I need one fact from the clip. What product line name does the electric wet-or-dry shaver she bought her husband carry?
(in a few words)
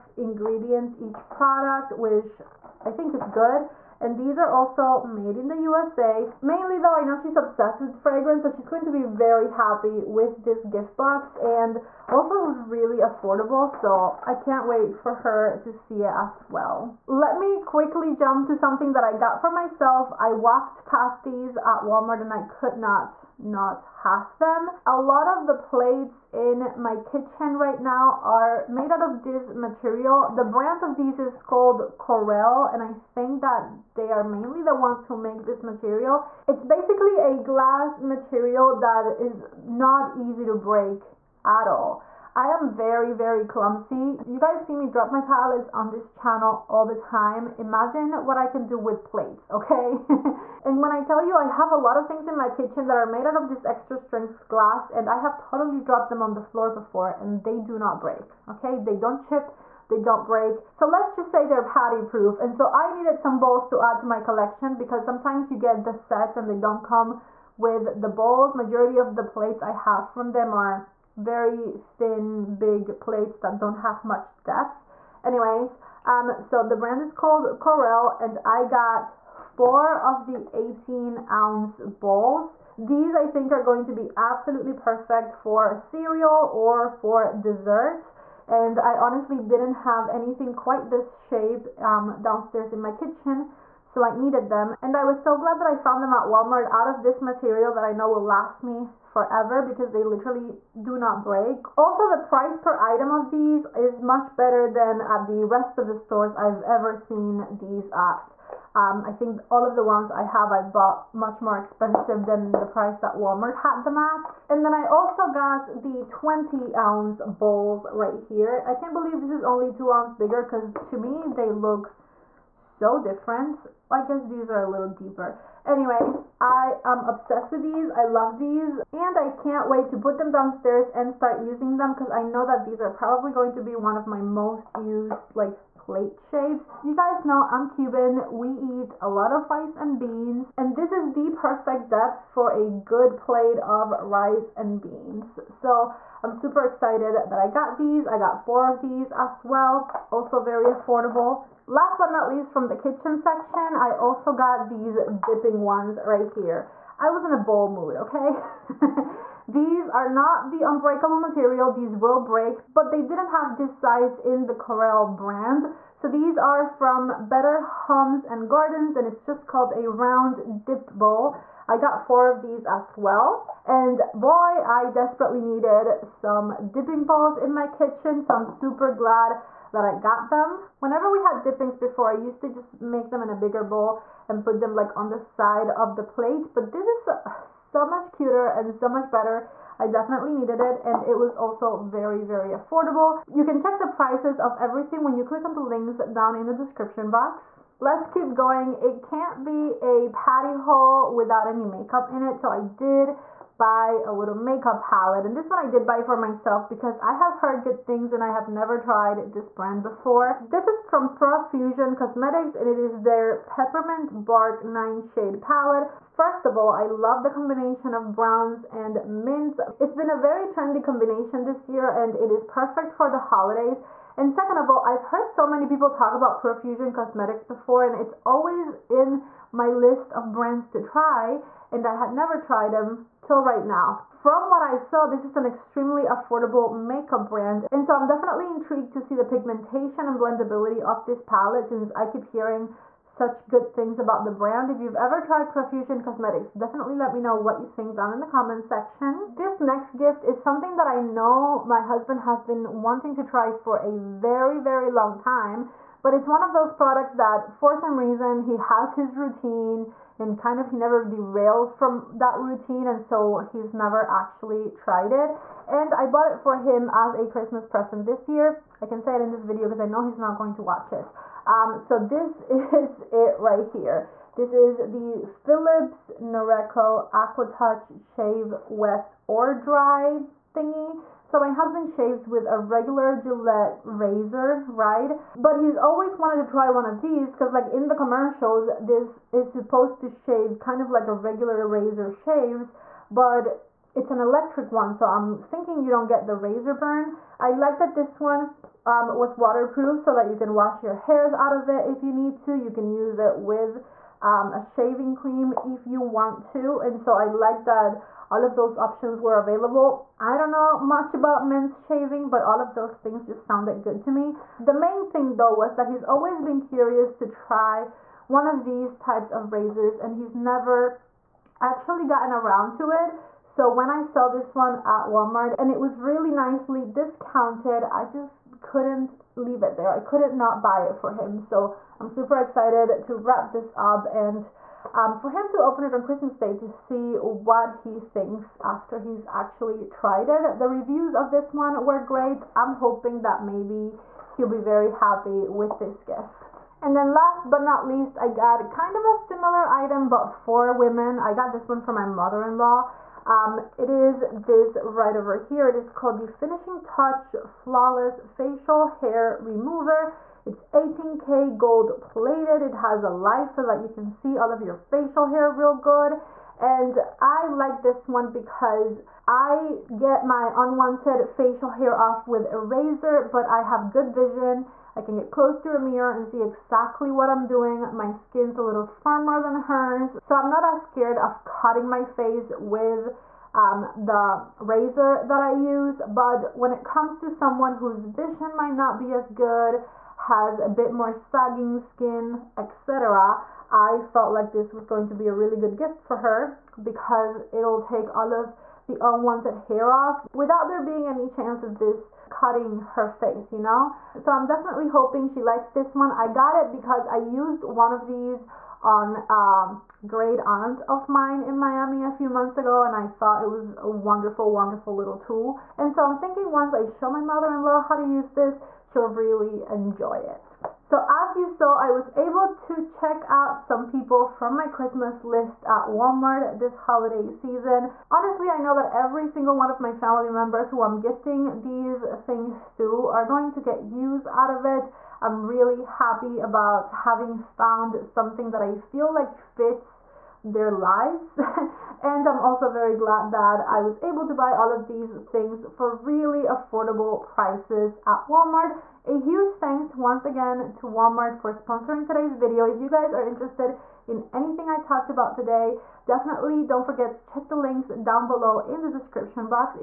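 Aqua Touch.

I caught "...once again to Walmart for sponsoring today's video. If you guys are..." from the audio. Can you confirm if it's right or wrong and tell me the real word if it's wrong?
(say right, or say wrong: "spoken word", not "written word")
right.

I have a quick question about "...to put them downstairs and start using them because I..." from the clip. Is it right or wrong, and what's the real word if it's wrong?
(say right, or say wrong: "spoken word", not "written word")
right.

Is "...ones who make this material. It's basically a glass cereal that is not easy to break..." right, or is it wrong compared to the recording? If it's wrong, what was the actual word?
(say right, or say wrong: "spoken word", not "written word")
wrong: "material", not "cereal".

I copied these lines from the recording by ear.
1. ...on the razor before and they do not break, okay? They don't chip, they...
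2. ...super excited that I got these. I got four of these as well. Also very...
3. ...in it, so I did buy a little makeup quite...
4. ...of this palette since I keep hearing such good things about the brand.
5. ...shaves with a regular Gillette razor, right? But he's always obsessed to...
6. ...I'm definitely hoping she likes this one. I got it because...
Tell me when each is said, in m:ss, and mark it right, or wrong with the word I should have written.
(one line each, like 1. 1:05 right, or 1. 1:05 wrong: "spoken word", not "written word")
1. 0:56 wrong: "floor", not "razor"
2. 2:26 right
3. 3:22 wrong: "palette", not "quite"
4. 4:00 right
5. 4:41 wrong: "wanted", not "obsessed"
6. 6:44 right.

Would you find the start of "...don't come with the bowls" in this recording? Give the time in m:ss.
1:06.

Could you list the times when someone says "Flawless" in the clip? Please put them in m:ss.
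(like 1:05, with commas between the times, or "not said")
5:57.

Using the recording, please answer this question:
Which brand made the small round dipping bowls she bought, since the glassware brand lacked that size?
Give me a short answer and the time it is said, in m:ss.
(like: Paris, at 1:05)
Better Homes and Gardens, at 2:47.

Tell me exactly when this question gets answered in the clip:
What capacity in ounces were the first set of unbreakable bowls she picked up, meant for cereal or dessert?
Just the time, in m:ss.
1:20.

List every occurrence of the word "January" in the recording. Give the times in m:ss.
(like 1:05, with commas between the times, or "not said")
not said.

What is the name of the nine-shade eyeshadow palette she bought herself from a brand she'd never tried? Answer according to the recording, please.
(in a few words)
Peppermint Bark.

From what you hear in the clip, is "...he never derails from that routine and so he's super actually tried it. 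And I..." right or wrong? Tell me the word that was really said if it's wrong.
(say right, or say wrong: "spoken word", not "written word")
wrong: "never", not "super".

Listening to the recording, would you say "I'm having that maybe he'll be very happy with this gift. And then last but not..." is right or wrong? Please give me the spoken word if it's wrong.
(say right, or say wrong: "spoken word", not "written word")
wrong: "hoping", not "having".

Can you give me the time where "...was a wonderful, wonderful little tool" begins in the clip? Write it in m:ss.
6:53.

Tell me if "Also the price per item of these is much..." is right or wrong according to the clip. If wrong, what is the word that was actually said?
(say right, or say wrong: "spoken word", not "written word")
right.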